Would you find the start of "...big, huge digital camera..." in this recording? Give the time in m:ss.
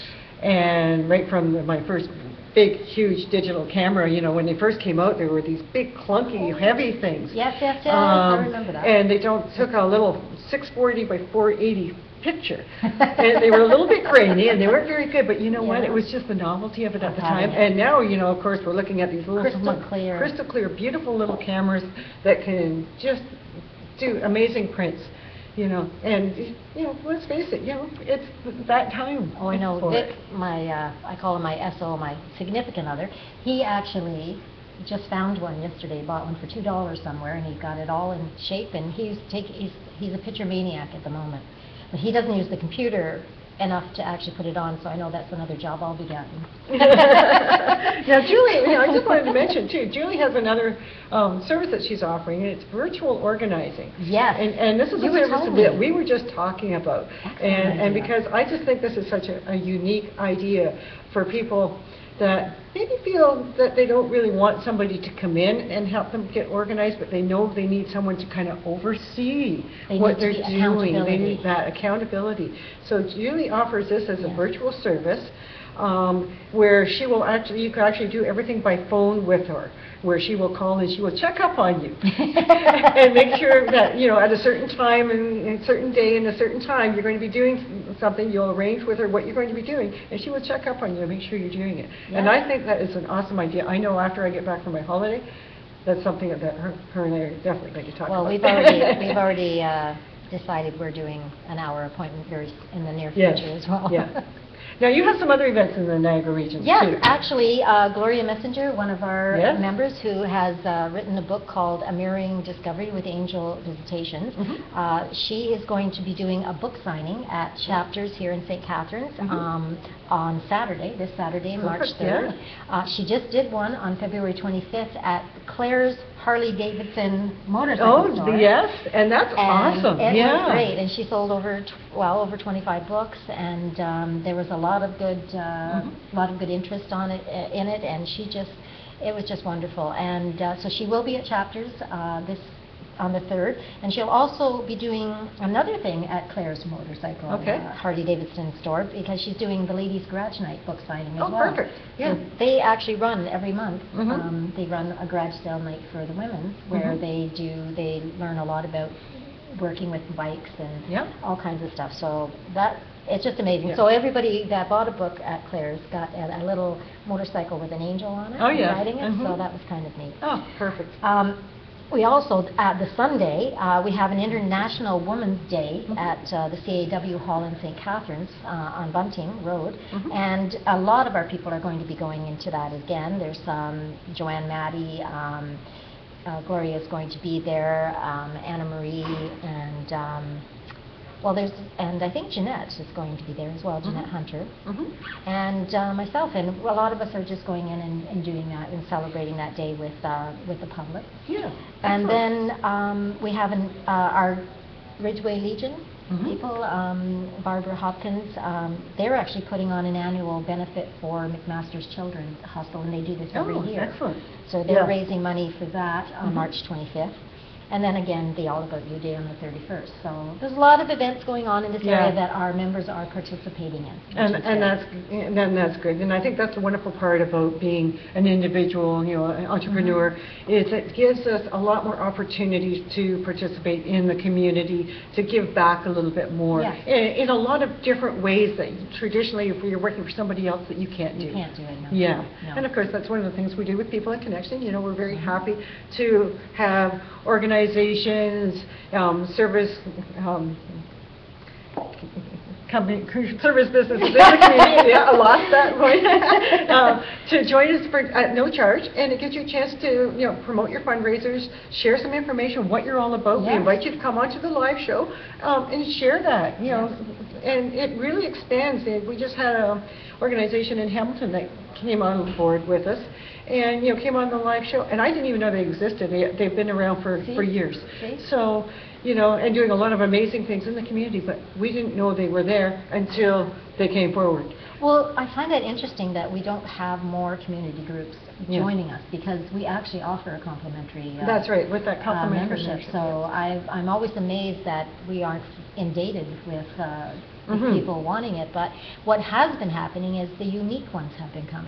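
0:02.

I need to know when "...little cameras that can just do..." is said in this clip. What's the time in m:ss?
0:21.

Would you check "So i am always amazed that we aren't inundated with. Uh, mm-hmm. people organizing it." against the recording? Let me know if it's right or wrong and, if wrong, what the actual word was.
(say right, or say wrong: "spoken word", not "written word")
wrong: "wanting", not "organizing".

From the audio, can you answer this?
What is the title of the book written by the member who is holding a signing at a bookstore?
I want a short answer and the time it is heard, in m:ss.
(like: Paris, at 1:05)
A Mirroring Discovery with Angel Visitations, at 1:51.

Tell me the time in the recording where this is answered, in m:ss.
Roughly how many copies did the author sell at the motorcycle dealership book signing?
2:11.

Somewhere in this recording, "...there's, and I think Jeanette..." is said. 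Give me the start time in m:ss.
3:11.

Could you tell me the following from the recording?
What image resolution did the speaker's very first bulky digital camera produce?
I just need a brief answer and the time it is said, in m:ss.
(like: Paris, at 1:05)
640 by 480, at 0:10.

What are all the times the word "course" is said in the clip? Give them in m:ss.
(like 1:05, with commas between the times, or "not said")
0:18, 4:02.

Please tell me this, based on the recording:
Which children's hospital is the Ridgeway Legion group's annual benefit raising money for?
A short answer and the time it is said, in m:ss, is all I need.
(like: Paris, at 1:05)
McMaster Children's Hospital, at 3:31.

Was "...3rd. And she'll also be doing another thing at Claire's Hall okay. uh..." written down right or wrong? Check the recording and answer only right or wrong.
wrong.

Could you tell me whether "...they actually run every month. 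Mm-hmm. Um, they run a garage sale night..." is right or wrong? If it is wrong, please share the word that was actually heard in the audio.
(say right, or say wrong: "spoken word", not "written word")
right.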